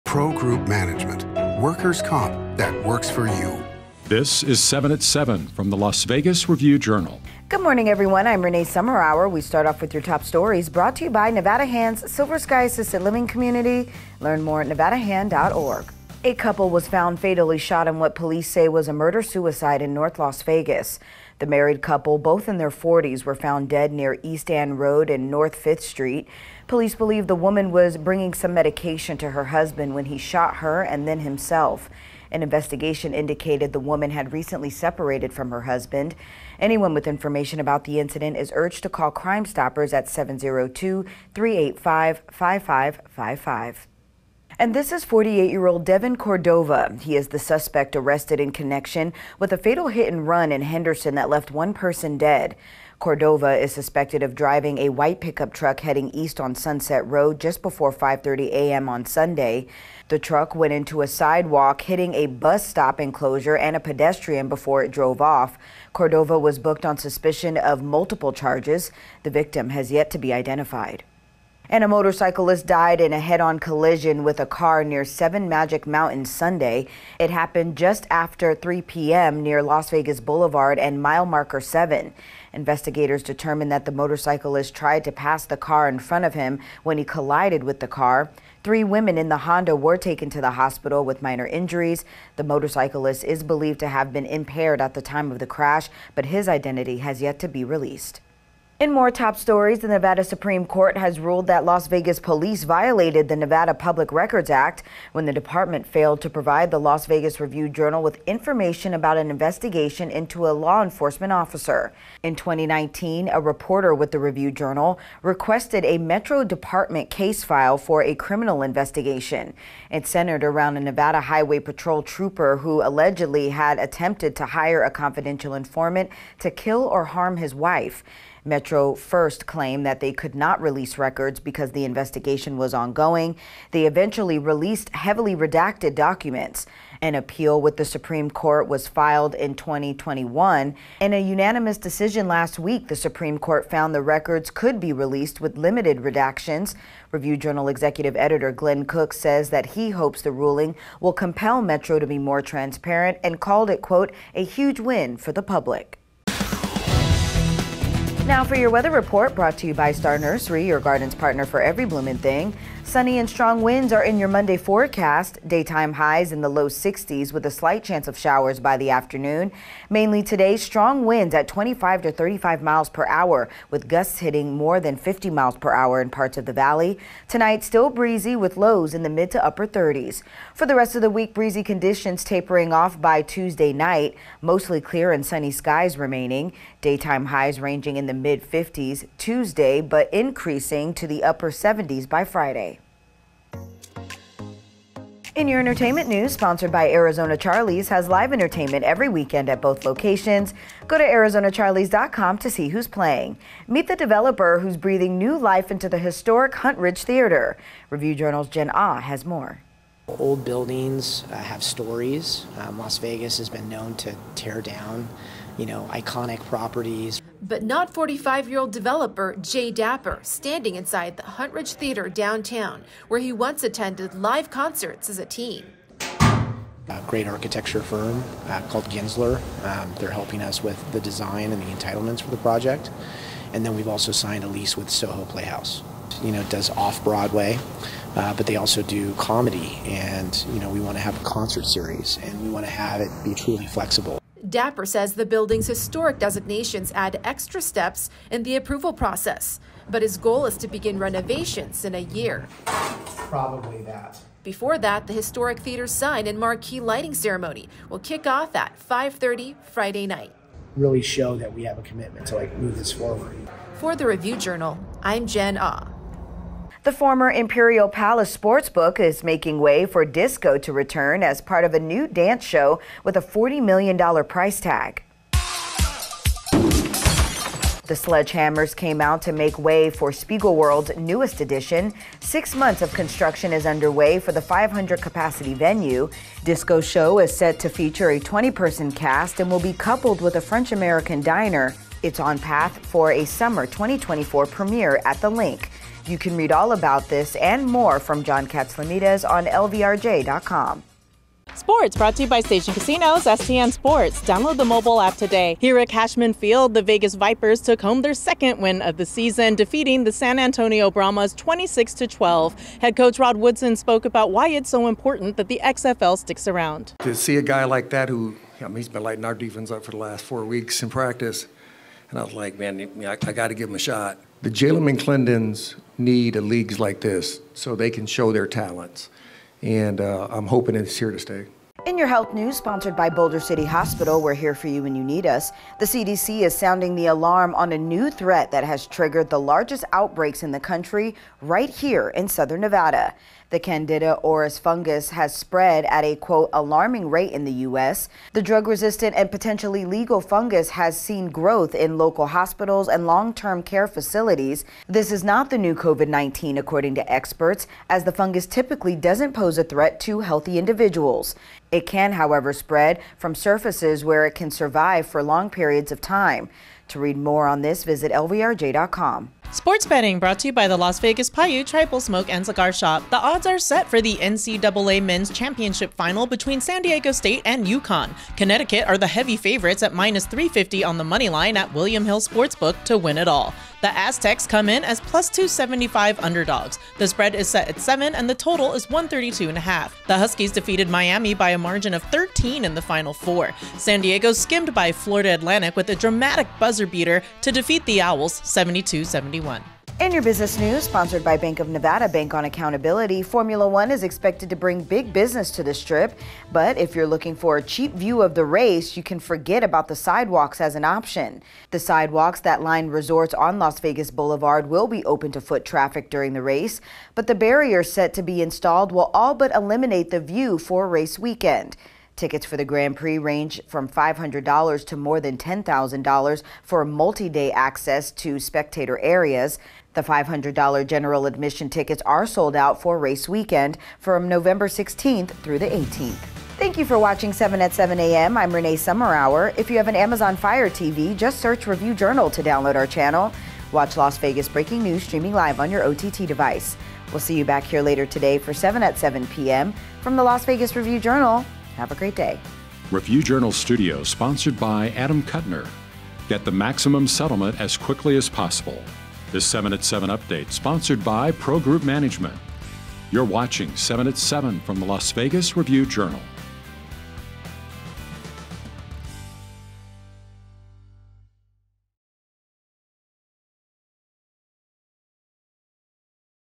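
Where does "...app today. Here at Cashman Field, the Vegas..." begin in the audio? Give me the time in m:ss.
5:05.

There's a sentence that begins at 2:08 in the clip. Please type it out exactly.
Metro first claimed that they could not release records because the investigation was ongoing.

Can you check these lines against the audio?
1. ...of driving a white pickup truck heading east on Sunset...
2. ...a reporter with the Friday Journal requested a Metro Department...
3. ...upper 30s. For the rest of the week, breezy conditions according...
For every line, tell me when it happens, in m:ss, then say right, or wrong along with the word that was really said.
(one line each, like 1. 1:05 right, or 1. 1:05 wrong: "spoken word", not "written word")
1. 0:54 right
2. 1:53 wrong: "Review", not "Friday"
3. 2:59 wrong: "tapering", not "according".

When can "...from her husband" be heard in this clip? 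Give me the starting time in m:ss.
0:35.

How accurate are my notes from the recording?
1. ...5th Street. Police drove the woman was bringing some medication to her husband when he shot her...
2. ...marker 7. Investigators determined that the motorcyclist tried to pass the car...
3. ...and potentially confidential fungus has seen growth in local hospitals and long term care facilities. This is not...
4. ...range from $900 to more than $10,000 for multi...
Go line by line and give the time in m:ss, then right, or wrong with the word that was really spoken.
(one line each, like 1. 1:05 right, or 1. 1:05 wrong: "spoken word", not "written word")
1. 0:25 wrong: "believe", not "drove"
2. 1:21 right
3. 5:49 wrong: "legal", not "confidential"
4. 7:03 wrong: "500", not "900".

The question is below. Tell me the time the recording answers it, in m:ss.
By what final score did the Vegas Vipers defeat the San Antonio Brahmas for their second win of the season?
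5:11.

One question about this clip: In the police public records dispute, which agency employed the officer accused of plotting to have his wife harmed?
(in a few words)
Nevada Highway Patrol.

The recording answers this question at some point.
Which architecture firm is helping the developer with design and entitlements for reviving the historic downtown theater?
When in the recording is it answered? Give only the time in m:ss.
3:48.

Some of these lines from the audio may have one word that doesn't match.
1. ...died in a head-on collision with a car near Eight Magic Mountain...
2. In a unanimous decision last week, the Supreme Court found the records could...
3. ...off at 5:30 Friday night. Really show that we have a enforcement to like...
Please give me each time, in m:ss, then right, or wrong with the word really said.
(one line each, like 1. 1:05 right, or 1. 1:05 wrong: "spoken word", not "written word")
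1. 1:12 wrong: "Seven", not "Eight"
2. 2:21 right
3. 4:18 wrong: "commitment", not "enforcement".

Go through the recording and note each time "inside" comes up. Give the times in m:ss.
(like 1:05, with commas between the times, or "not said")
3:40.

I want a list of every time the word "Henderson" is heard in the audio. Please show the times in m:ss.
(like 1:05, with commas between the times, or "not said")
0:50.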